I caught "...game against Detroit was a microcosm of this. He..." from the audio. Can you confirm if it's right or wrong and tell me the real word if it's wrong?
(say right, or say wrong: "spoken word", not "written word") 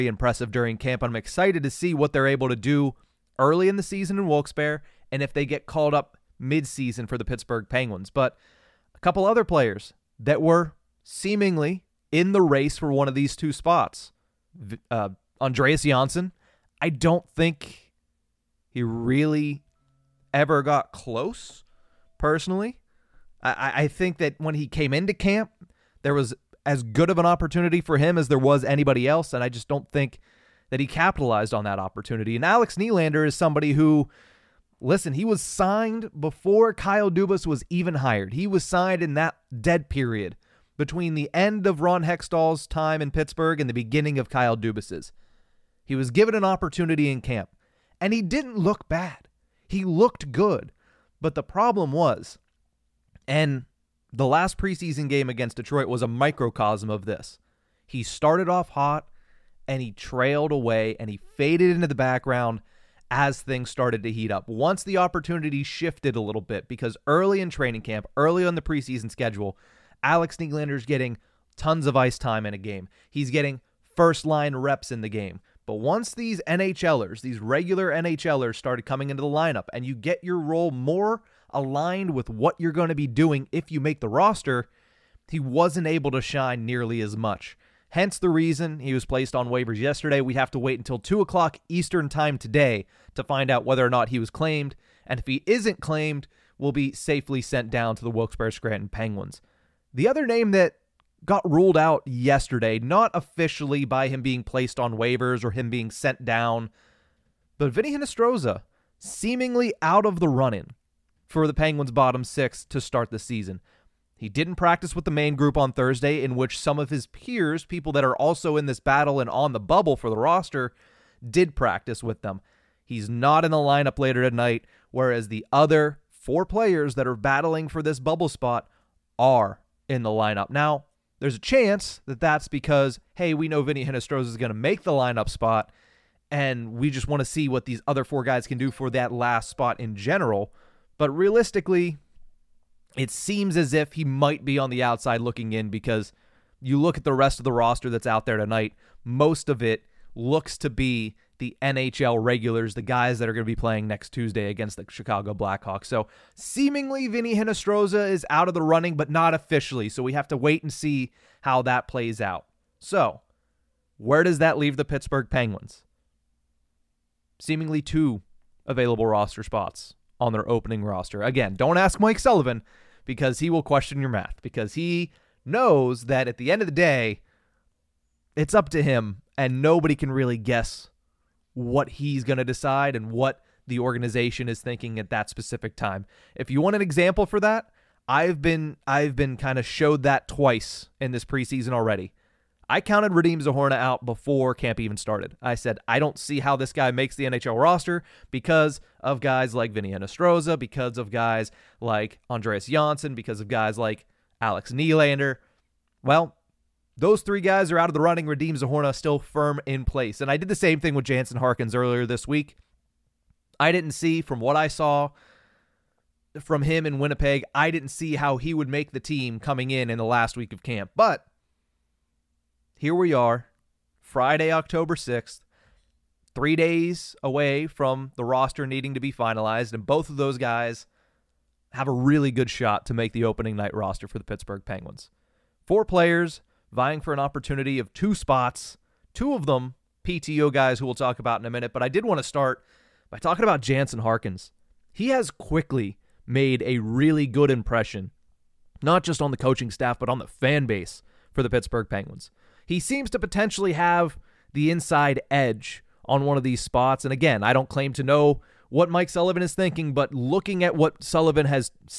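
right.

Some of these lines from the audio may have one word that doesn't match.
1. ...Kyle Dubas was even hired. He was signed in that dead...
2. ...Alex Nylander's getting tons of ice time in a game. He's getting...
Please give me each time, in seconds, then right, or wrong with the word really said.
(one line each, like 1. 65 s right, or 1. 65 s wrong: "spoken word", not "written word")
1. 36 s right
2. 70 s right.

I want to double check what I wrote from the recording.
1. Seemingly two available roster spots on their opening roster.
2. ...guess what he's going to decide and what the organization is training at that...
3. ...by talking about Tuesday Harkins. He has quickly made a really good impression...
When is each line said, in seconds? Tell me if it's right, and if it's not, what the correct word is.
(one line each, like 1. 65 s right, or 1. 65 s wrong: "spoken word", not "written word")
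1. 167 s right
2. 180 s wrong: "thinking", not "training"
3. 243 s wrong: "Jansen", not "Tuesday".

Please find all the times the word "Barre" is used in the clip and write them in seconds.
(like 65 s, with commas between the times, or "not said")
4 s, 98 s.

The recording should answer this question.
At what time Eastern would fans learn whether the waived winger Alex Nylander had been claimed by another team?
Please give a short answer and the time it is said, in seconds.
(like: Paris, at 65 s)
2 o'clock, at 90 s.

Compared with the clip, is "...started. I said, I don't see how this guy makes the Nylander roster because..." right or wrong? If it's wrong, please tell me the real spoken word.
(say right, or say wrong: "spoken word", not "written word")
wrong: "NHL", not "Nylander".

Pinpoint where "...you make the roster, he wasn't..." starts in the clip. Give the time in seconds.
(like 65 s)
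83 s.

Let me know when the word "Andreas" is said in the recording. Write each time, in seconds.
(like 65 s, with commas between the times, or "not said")
15 s, 202 s.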